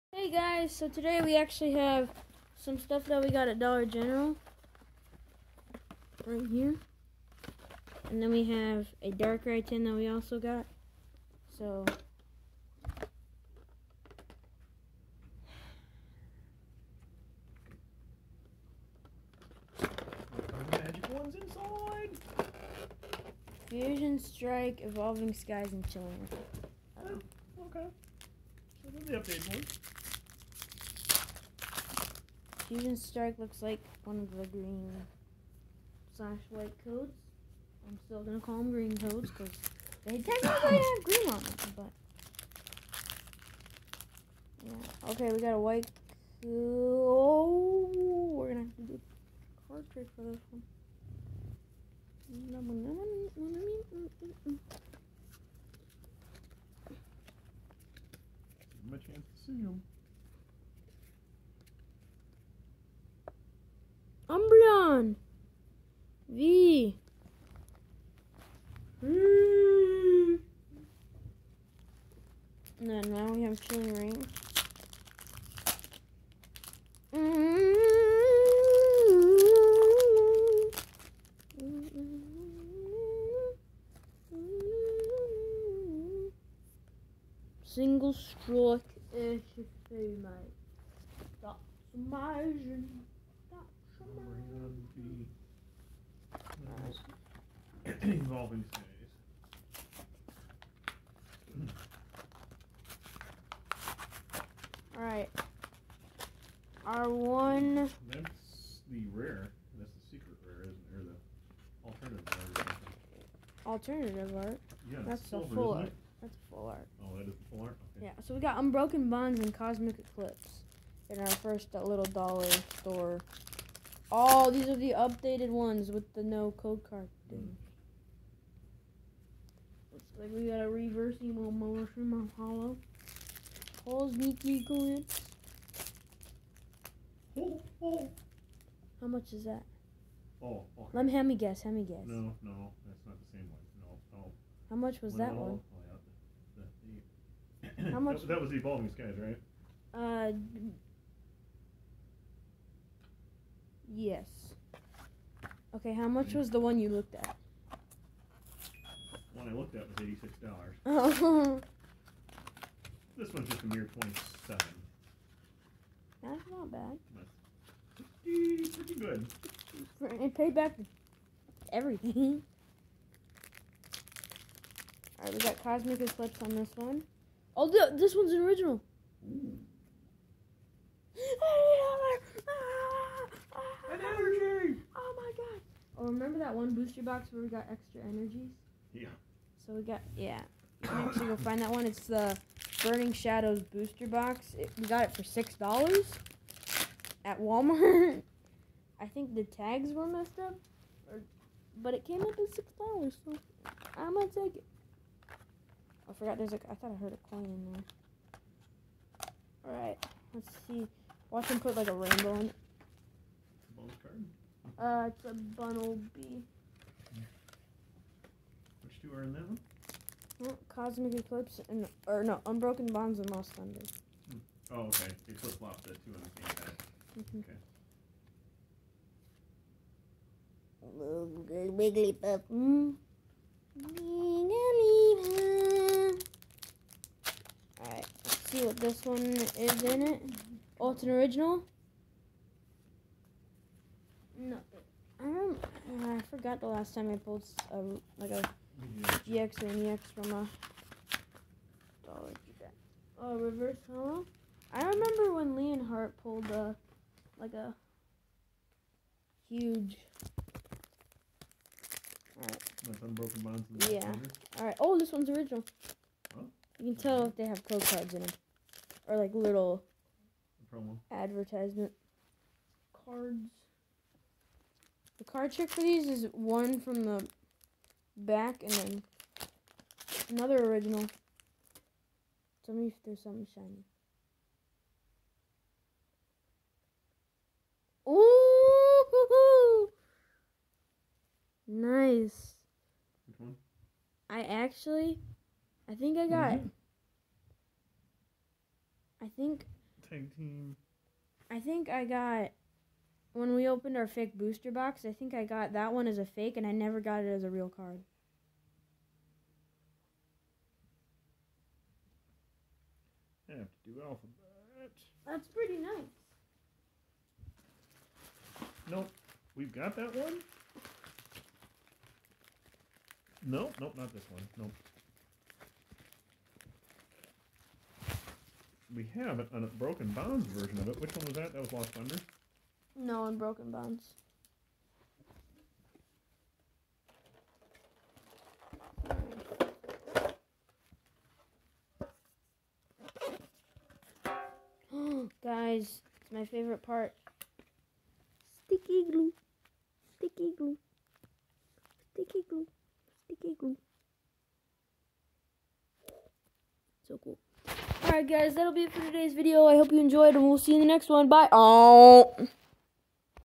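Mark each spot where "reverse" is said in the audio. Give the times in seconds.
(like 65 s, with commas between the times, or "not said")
130 s, 253 s.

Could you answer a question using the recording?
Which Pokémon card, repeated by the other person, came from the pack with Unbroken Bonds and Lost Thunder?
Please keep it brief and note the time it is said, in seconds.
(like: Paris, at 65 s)
Wigglytuff, at 231 s.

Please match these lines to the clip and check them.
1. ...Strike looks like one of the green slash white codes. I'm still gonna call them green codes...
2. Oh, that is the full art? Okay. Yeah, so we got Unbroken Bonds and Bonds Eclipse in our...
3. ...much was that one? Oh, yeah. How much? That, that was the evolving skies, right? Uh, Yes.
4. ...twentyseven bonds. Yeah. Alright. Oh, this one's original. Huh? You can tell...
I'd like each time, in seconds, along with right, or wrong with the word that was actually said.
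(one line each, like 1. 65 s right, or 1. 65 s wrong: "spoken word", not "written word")
1. 32 s right
2. 117 s wrong: "Cosmic", not "Bonds"
3. 144 s right
4. 263 s wrong: "unbroken", not "twentyseven".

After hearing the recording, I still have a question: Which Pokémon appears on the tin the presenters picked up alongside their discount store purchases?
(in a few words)
Darkrai.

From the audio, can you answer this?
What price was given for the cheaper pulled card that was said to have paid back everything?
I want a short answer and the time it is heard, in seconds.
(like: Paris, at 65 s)
$27, at 163 s.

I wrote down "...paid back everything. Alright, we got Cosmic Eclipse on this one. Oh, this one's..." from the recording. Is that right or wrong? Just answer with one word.
right.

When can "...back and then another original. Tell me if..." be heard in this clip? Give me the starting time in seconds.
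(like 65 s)
278 s.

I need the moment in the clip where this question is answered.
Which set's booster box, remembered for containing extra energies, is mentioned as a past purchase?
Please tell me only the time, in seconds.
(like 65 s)
192 s.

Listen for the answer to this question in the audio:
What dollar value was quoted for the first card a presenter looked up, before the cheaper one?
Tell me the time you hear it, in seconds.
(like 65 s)
160 s.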